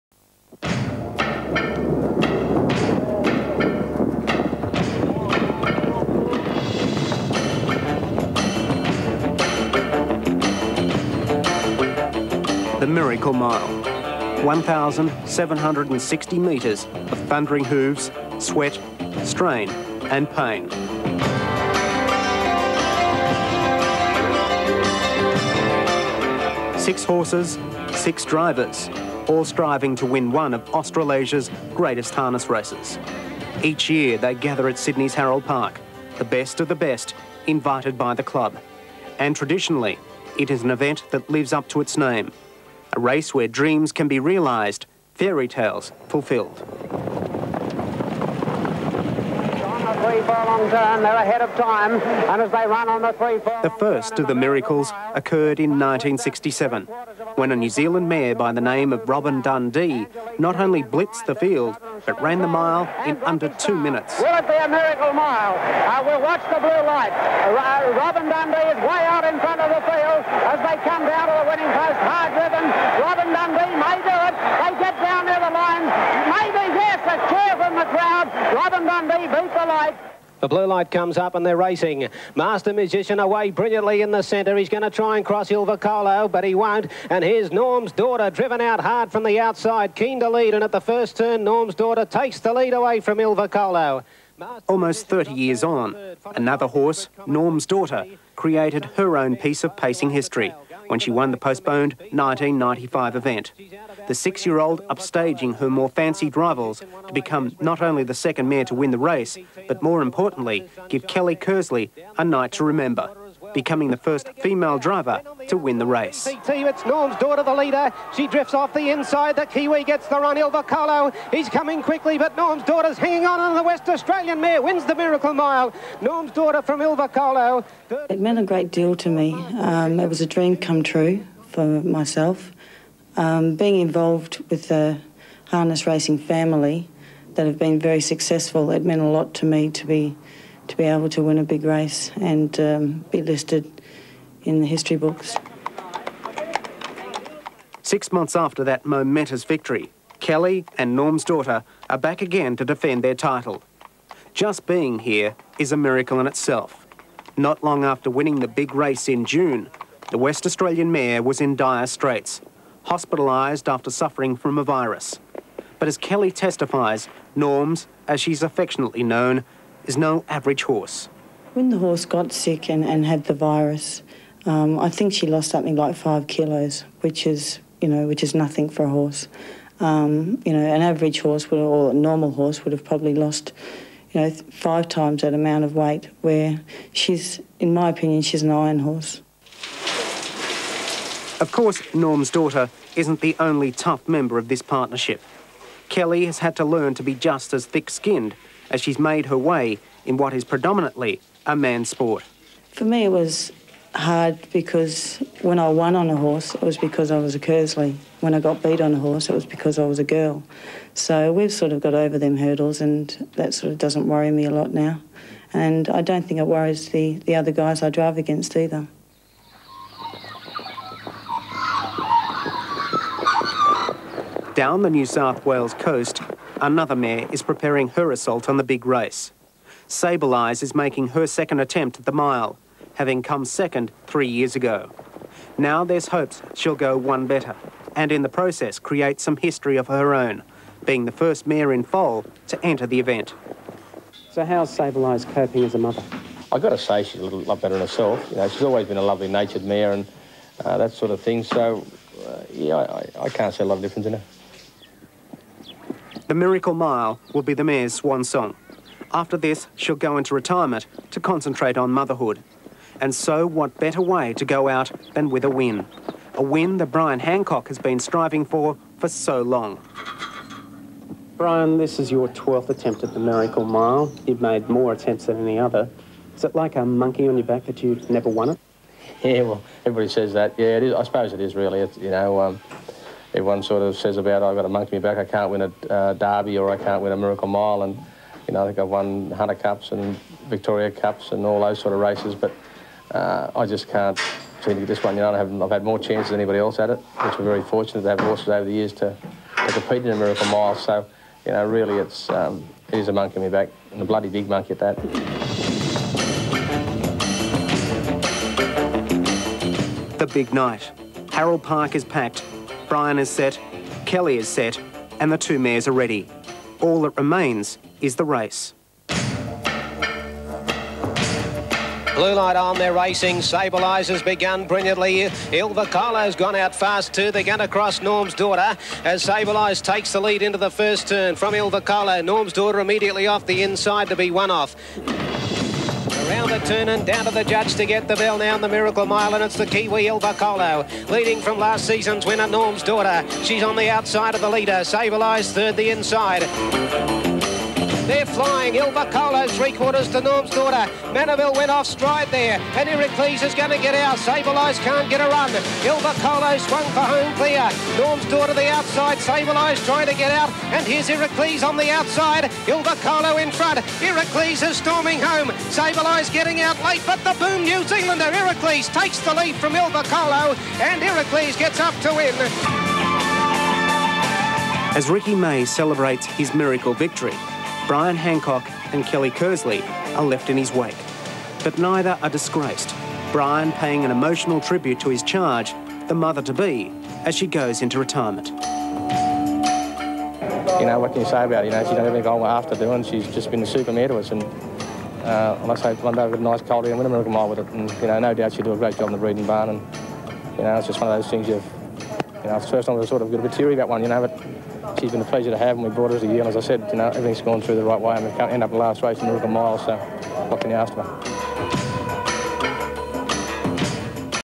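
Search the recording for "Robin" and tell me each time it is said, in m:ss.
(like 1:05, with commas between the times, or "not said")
0:59, 1:07, 1:12, 1:18.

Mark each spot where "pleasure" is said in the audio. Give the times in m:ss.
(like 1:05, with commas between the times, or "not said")
6:45.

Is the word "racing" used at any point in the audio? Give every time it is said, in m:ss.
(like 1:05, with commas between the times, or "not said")
1:21, 2:15, 5:22.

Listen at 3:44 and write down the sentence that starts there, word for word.
Down the New South Wales coast, Another mare is preparing her assault on the big race.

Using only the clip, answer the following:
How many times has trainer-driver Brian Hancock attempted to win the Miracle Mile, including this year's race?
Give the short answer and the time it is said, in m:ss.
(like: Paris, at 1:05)
12, at 4:32.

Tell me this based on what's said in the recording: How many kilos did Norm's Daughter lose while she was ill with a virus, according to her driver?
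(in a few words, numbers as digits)
5 kilos.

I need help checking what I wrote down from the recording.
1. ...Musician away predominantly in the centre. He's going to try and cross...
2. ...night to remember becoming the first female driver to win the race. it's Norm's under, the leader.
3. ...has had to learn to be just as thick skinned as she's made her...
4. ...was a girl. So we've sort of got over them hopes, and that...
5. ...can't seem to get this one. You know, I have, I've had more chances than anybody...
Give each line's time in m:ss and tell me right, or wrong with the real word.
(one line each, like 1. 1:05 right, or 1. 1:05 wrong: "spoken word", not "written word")
1. 1:22 wrong: "brilliantly", not "predominantly"
2. 1:52 wrong: "daughter", not "under"
3. 3:16 right
4. 3:29 wrong: "hurdles", not "hopes"
5. 4:53 right.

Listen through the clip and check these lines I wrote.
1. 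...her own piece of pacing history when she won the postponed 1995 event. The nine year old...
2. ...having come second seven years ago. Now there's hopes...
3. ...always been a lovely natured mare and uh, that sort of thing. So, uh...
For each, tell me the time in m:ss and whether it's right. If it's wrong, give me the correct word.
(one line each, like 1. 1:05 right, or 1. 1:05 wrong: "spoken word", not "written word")
1. 1:38 wrong: "six", not "nine"
2. 3:52 wrong: "three", not "seven"
3. 4:08 right.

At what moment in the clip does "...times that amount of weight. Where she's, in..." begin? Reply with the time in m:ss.
3:04.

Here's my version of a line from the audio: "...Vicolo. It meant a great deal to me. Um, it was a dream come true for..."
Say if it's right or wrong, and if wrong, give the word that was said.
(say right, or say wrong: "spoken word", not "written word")
right.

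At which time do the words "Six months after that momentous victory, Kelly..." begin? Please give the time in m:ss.
2:27.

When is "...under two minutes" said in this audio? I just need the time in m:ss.
1:03.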